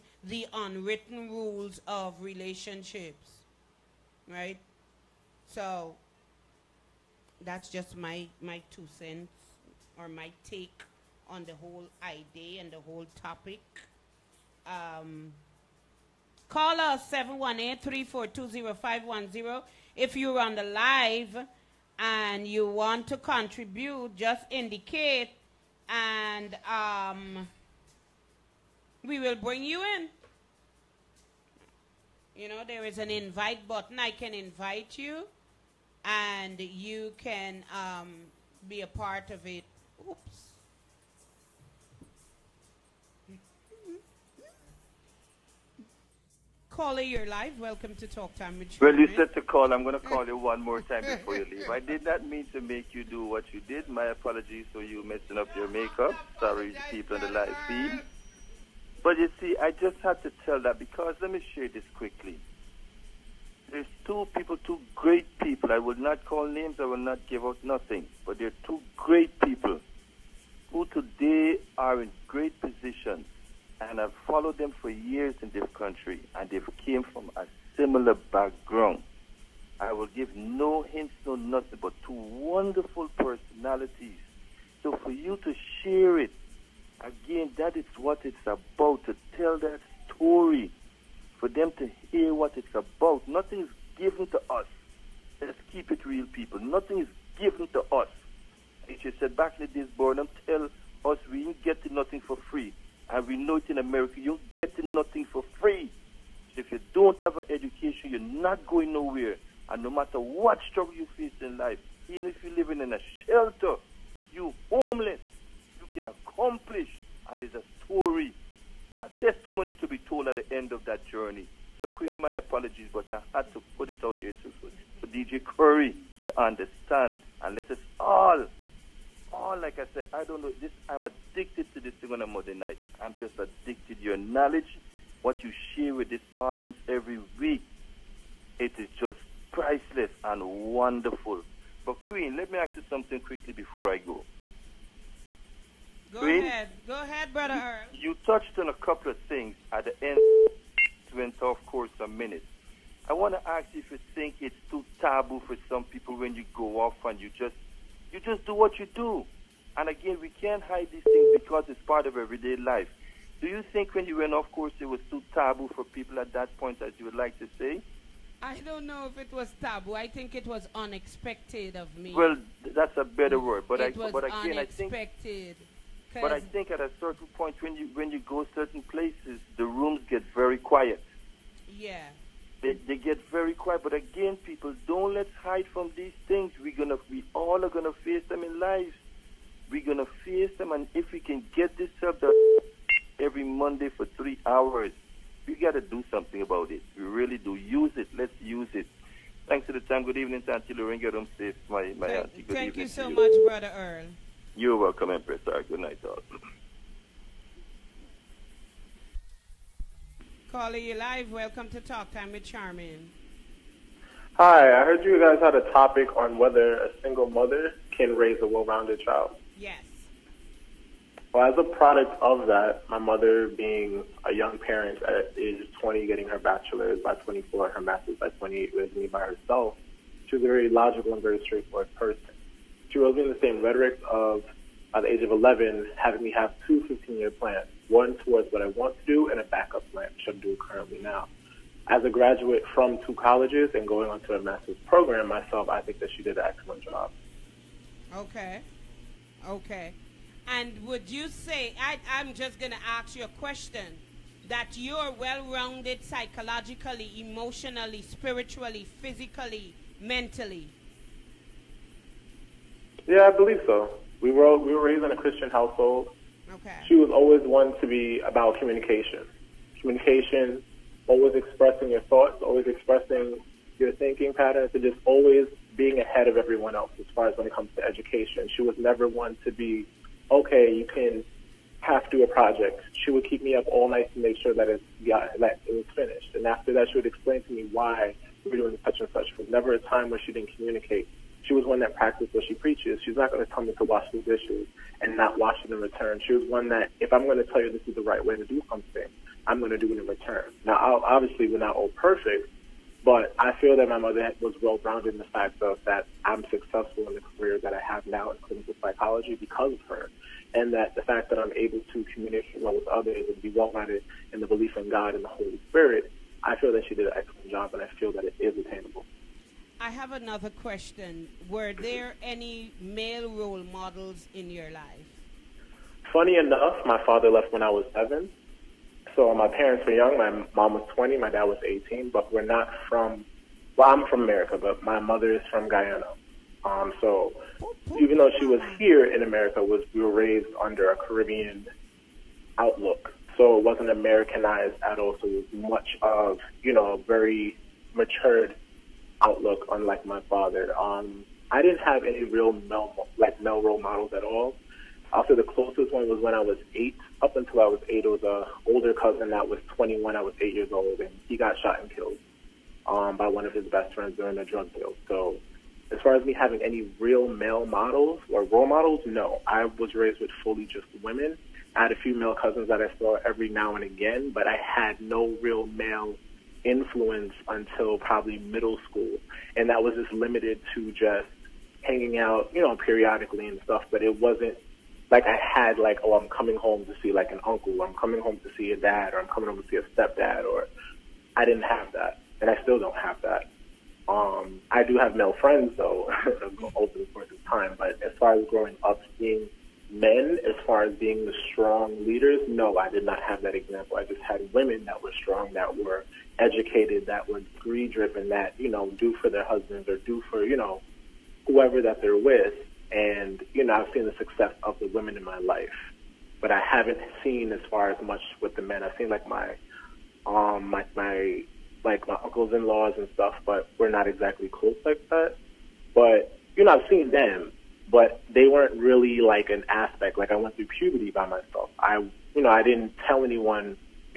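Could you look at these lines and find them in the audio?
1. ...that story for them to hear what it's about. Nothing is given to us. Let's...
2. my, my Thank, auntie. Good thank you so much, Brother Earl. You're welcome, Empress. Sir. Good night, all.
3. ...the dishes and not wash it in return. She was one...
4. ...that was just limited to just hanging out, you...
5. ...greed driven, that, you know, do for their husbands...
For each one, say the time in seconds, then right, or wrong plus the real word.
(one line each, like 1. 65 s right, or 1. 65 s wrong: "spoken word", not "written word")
1. 89 s right
2. 201 s right
3. 294 s right
4. 379 s right
5. 407 s right.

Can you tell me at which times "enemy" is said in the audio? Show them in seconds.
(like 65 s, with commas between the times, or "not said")
not said.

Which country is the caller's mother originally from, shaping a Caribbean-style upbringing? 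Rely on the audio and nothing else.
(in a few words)
Guyana.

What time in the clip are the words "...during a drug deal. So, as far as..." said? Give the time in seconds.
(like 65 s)
364 s.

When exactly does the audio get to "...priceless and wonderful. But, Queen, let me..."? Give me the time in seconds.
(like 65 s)
139 s.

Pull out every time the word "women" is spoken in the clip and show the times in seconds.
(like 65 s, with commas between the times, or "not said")
371 s, 404 s, 414 s.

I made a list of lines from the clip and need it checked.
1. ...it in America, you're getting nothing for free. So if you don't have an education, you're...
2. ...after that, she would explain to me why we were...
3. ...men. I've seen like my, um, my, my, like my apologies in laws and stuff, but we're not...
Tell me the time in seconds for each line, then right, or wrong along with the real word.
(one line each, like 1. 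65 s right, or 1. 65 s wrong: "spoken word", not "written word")
1. 103 s right
2. 286 s right
3. 418 s wrong: "uncles", not "apologies".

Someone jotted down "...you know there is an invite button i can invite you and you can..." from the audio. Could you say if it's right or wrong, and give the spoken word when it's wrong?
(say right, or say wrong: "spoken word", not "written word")
right.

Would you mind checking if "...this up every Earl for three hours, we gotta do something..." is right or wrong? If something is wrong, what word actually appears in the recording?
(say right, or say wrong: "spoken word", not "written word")
wrong: "Monday", not "Earl".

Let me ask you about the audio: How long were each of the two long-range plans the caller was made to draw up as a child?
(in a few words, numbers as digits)
15 years.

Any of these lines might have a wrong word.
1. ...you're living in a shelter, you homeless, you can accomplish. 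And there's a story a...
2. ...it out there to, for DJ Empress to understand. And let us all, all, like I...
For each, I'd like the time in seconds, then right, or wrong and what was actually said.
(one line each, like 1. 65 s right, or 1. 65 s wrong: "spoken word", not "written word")
1. 112 s right
2. 123 s wrong: "Curry", not "Empress".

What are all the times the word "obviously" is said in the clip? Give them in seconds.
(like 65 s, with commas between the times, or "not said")
301 s.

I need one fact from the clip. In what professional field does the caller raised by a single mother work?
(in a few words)
clinical psychology.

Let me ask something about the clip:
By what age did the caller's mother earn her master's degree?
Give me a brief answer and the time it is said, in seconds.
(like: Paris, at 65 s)
28, at 227 s.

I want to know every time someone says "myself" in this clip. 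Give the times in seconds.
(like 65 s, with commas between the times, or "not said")
245 s, 431 s.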